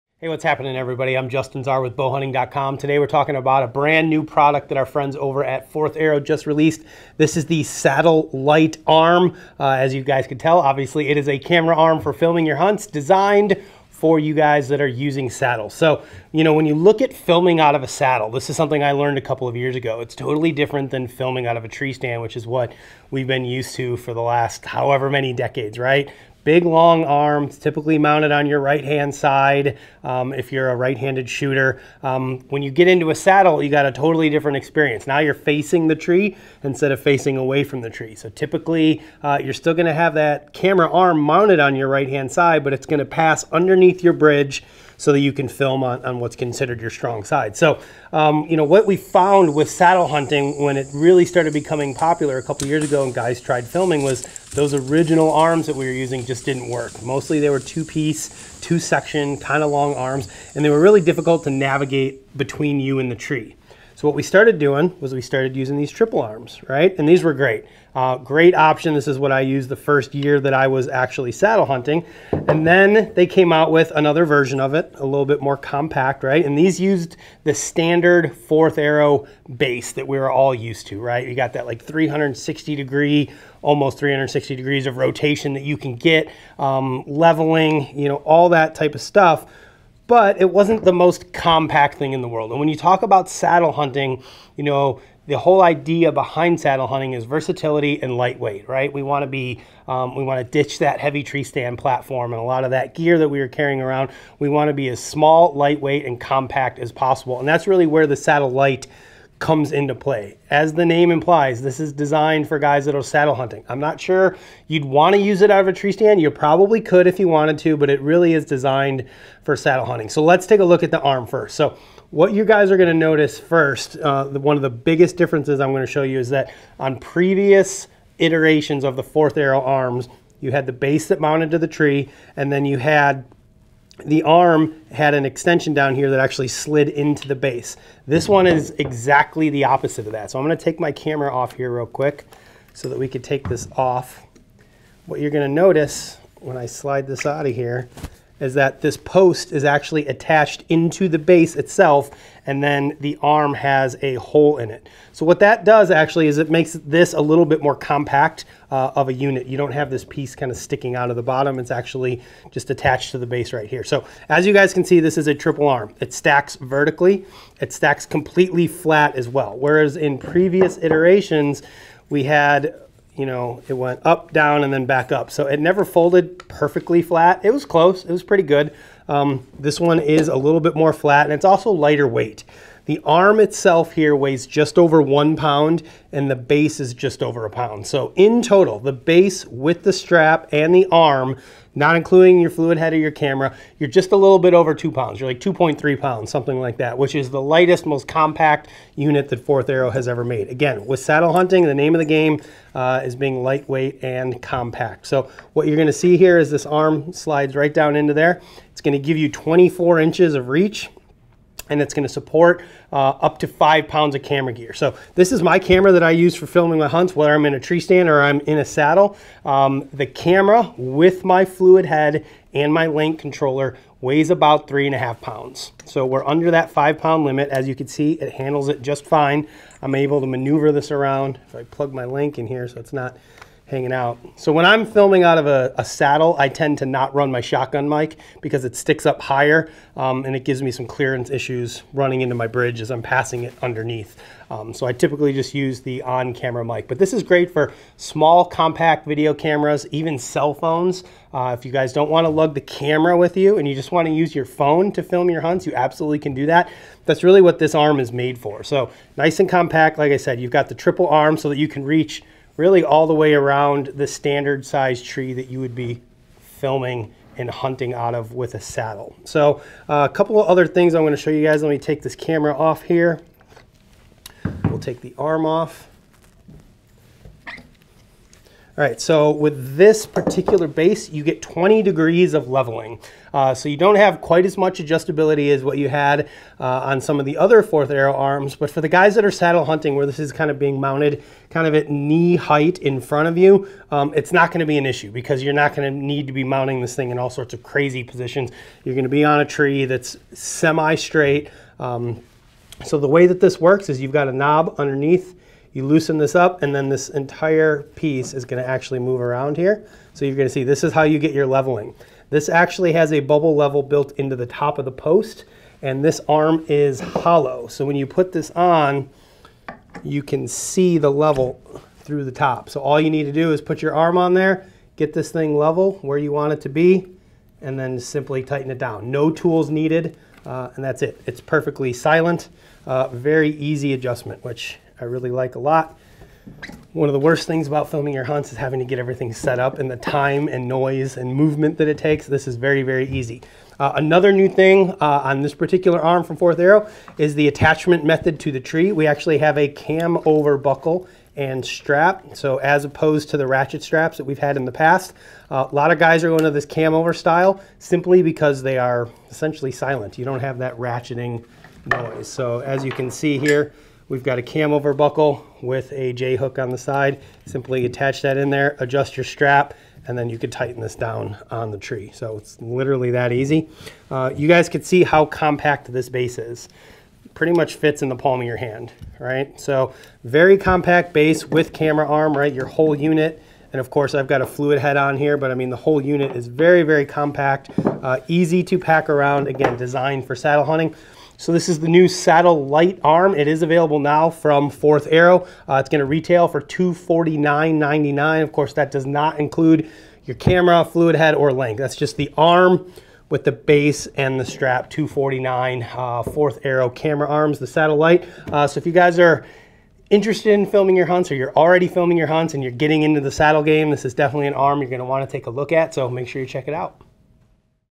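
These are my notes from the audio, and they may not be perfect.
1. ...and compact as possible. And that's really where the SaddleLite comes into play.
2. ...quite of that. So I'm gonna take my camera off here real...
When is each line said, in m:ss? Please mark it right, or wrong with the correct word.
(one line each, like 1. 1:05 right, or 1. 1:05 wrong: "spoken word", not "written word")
1. 1:46 right
2. 2:19 wrong: "opposite", not "quite".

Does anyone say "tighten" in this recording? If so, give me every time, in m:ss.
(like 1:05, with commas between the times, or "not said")
5:28, 6:10.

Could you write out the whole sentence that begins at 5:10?
So you're gonna see this is how you get your leveling.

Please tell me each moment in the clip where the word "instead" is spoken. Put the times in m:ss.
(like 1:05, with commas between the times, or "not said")
0:36.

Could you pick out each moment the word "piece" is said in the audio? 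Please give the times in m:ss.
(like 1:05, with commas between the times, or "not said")
0:57, 2:40, 5:07.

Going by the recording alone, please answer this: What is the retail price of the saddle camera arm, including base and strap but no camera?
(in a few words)
$249.99.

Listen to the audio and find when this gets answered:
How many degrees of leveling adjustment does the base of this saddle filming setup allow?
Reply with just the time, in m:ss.
4:41.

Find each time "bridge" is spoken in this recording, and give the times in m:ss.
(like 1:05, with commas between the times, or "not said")
0:44, 4:02.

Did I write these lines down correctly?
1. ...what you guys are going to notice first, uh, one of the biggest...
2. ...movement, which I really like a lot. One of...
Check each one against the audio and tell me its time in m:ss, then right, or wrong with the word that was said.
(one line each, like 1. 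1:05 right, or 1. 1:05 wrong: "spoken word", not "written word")
1. 2:02 right
2. 5:33 wrong: "adjustment", not "movement".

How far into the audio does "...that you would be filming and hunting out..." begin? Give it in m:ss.
4:25.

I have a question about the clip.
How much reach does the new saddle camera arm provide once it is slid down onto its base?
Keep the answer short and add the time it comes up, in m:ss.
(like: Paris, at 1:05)
24 inches, at 3:29.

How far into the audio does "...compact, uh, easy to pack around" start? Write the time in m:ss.
6:27.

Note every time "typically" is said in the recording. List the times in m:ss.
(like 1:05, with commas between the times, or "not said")
0:27, 0:38, 4:04.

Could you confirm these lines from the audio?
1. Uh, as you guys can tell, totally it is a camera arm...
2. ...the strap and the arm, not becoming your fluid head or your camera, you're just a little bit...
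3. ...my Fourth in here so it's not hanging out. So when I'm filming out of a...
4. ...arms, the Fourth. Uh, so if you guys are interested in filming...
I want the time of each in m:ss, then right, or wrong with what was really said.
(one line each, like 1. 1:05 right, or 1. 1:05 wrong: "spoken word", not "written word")
1. 0:09 wrong: "obviously", not "totally"
2. 3:09 wrong: "including", not "becoming"
3. 3:51 wrong: "LANC", not "Fourth"
4. 6:47 wrong: "SaddleLite", not "Fourth".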